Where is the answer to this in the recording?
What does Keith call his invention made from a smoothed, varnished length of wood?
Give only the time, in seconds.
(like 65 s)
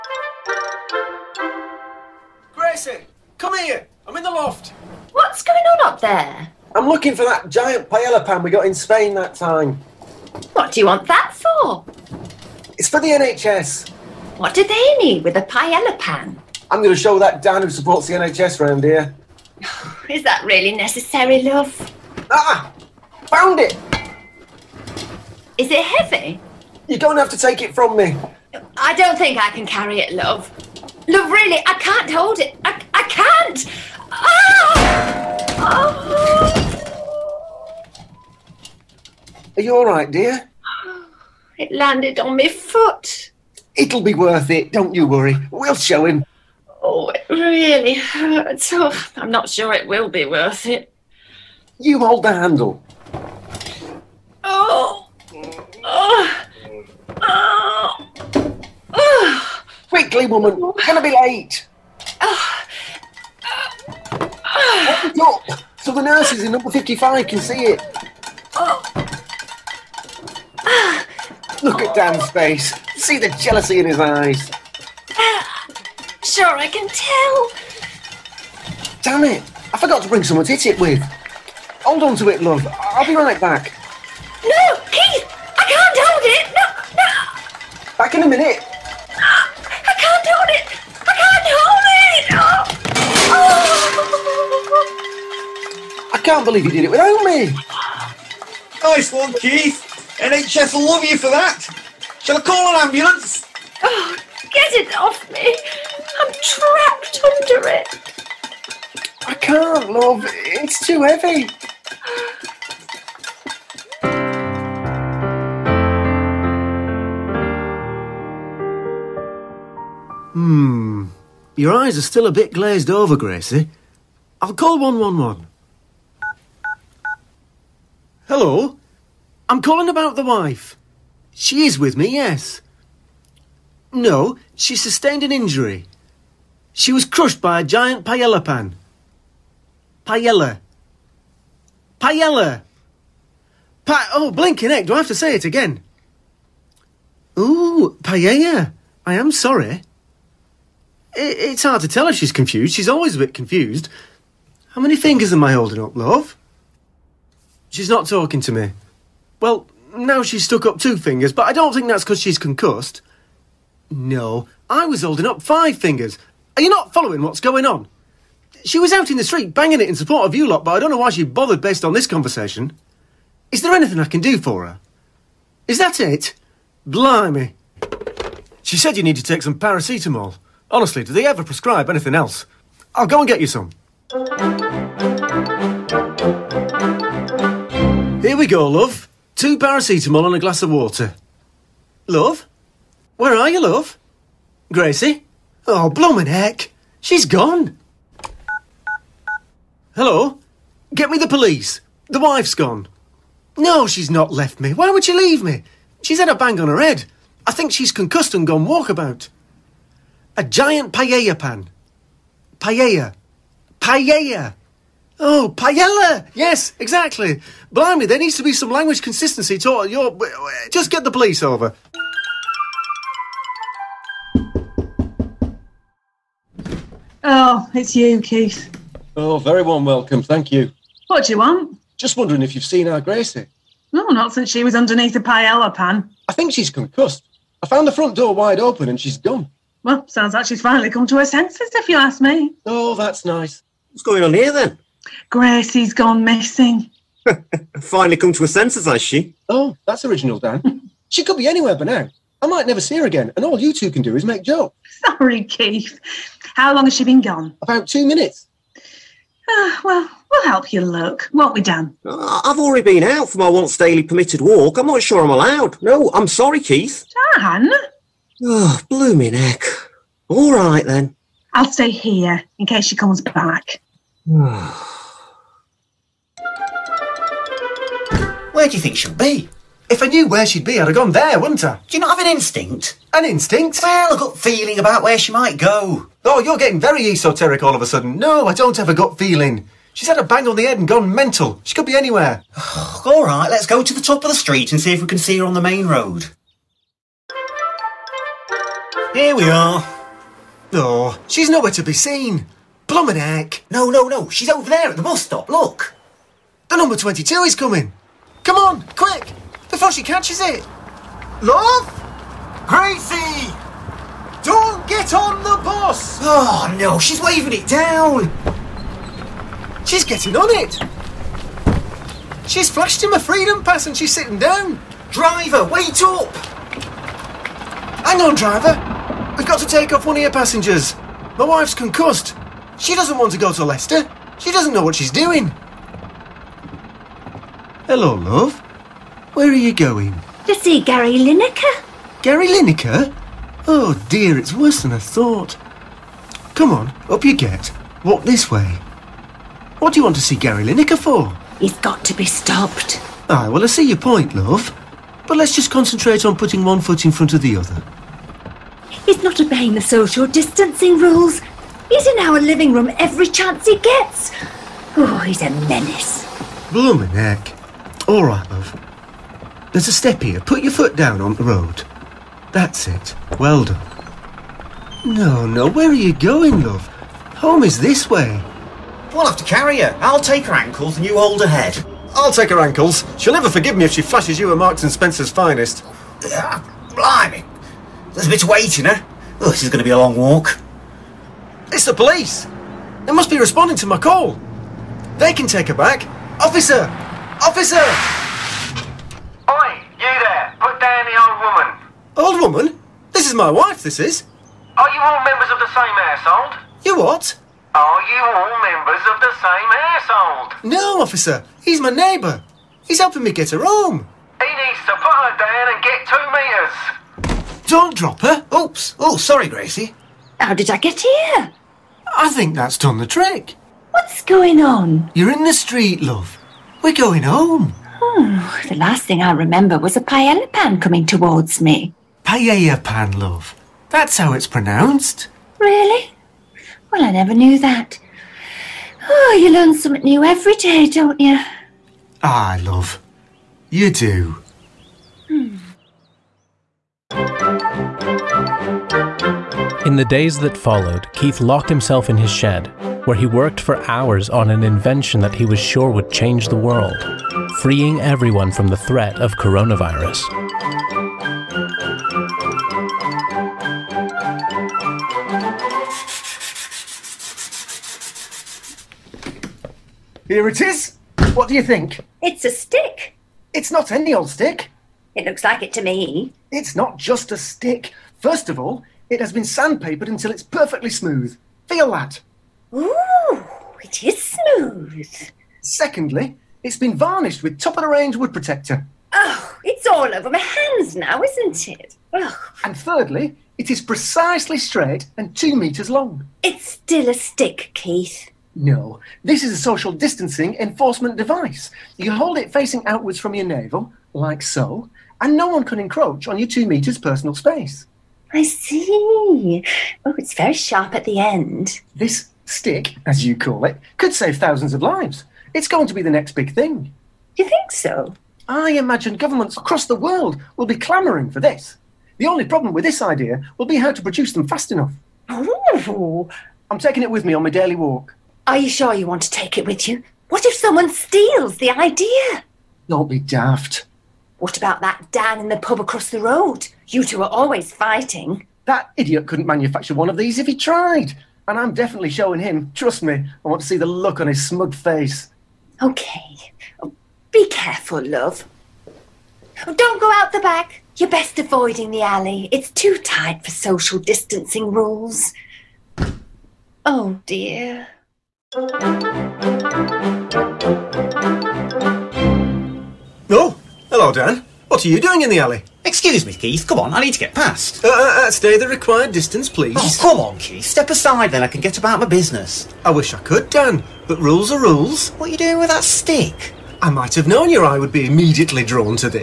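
499 s.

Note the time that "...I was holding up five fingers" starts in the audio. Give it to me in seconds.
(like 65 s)
164 s.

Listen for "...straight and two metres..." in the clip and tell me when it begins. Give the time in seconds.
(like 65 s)
494 s.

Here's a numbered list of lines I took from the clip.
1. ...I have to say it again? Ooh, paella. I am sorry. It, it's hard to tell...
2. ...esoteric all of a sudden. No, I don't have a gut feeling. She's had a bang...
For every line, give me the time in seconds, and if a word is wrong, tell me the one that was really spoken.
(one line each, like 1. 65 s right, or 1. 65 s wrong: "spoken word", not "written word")
1. 144 s right
2. 287 s right.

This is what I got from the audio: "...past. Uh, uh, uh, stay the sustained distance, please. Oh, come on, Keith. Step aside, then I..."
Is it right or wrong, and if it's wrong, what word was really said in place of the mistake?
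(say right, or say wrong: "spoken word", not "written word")
wrong: "required", not "sustained".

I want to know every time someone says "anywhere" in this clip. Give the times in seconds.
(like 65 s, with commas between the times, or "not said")
251 s, 291 s.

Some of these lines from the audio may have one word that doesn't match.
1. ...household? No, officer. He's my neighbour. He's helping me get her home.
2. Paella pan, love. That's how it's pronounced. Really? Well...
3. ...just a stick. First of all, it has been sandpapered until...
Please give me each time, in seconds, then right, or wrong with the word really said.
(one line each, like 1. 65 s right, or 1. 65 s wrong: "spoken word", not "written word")
1. 409 s right
2. 432 s right
3. 476 s right.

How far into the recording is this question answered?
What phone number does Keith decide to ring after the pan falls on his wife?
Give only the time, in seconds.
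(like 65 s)
124 s.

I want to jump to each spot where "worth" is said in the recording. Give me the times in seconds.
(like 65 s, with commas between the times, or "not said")
44 s, 50 s.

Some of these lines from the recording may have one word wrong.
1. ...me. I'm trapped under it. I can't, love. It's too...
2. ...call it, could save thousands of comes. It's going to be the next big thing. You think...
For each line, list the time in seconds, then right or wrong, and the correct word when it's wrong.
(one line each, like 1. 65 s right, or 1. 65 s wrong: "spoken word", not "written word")
1. 105 s right
2. 513 s wrong: "lives", not "comes".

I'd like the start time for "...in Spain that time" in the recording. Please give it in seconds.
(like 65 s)
8 s.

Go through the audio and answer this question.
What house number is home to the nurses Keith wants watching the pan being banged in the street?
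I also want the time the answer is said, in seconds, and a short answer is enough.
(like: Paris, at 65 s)
55, at 66 s.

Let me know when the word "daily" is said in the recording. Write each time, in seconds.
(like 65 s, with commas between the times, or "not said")
263 s, 527 s.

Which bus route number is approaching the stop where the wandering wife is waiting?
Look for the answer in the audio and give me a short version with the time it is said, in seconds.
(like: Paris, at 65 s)
22, at 306 s.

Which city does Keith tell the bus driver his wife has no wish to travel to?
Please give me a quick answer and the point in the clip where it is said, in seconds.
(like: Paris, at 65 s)
Leicester, at 333 s.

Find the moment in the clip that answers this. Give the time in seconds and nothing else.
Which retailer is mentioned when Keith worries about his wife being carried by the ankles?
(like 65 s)
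384 s.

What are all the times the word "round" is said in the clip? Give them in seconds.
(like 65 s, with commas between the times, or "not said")
18 s.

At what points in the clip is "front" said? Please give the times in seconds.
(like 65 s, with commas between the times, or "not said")
237 s, 357 s.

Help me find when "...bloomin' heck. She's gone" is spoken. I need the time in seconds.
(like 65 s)
195 s.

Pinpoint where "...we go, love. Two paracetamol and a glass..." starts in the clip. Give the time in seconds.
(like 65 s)
188 s.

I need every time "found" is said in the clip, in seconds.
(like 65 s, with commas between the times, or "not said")
23 s, 237 s.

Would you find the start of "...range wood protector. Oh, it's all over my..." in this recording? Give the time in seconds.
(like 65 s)
487 s.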